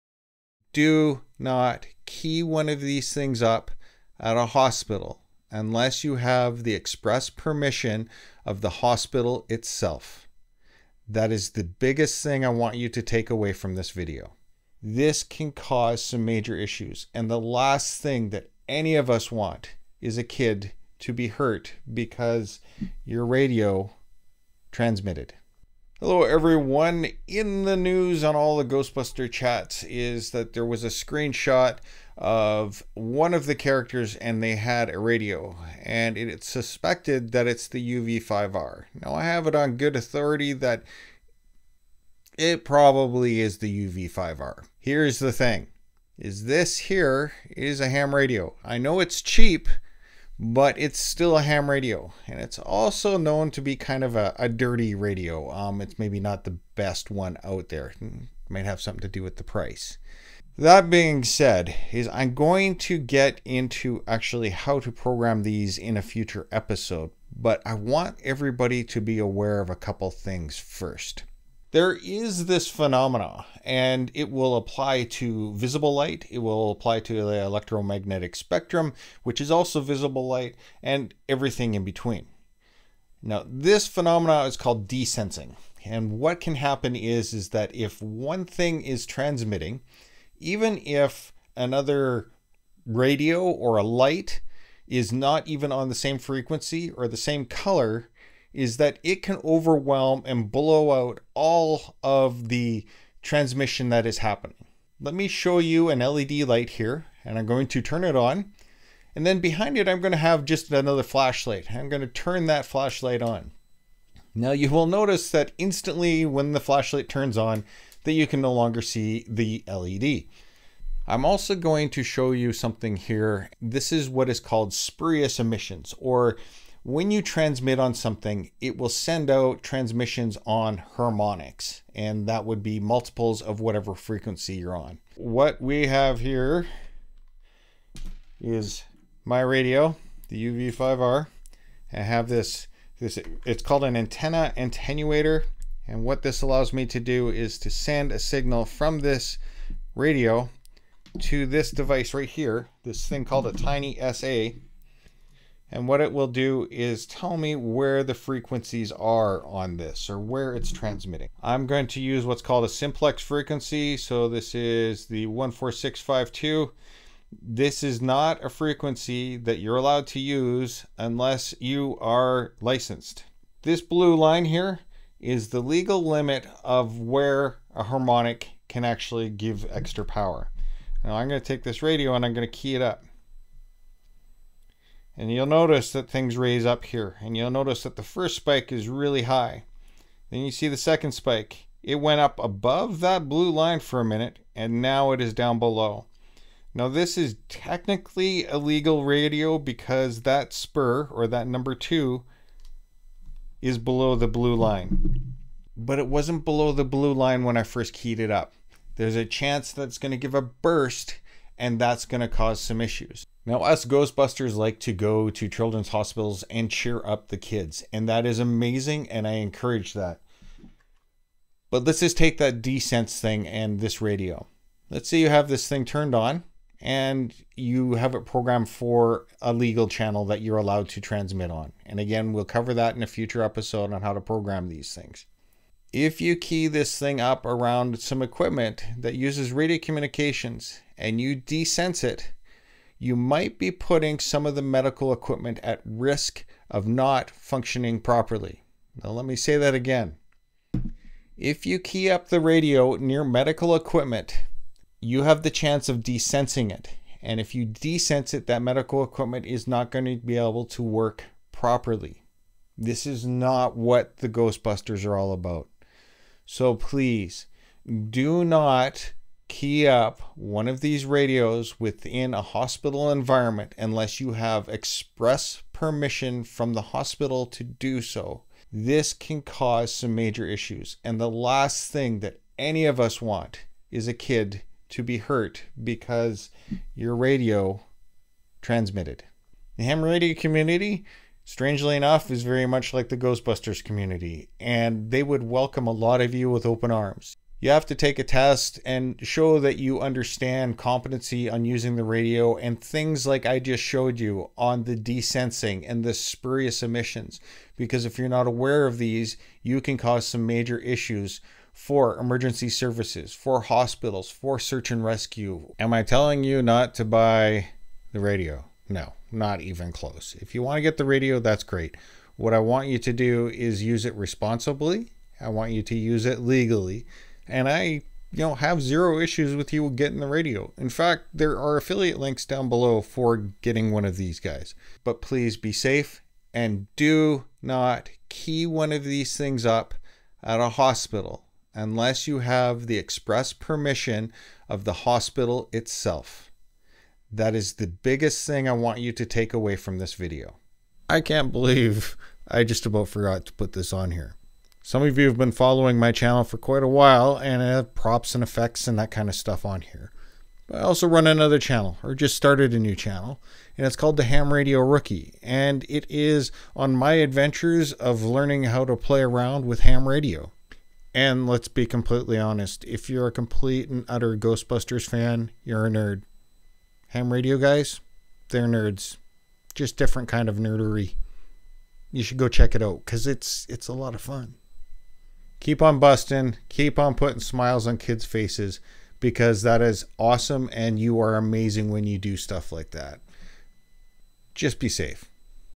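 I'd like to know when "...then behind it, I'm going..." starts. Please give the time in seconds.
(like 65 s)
109 s.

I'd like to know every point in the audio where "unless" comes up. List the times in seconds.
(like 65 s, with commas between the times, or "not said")
5 s, 170 s, 273 s, 341 s.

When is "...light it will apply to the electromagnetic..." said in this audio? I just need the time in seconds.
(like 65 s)
75 s.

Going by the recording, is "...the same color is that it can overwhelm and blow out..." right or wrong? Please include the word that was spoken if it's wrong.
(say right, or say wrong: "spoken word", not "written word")
right.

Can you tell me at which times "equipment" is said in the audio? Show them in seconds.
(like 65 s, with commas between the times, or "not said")
238 s, 245 s, 253 s, 259 s.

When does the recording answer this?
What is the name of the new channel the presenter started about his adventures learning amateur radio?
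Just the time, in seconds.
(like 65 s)
364 s.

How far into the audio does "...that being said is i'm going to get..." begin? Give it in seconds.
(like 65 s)
60 s.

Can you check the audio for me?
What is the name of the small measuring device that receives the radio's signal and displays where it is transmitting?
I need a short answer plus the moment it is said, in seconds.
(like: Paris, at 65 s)
tiny SA, at 153 s.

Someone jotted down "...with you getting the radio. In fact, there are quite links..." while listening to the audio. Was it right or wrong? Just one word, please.
wrong.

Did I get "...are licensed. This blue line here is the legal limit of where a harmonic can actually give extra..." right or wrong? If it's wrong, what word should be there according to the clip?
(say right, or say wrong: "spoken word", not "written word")
right.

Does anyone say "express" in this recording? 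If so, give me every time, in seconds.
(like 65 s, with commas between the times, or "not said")
6 s, 274 s, 342 s.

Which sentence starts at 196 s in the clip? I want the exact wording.
Now this is technically illegal radio because that spur, or that number two, is below the blue line.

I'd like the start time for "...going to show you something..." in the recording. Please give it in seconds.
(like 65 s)
121 s.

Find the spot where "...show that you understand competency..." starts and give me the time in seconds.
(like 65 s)
299 s.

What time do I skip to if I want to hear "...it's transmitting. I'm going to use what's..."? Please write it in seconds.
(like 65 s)
160 s.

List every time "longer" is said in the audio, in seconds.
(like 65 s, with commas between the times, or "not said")
118 s.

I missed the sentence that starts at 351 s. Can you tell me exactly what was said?
I can't believe I just about forgot to put this on here.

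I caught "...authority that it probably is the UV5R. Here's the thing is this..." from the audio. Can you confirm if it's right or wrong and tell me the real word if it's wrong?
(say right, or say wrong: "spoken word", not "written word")
right.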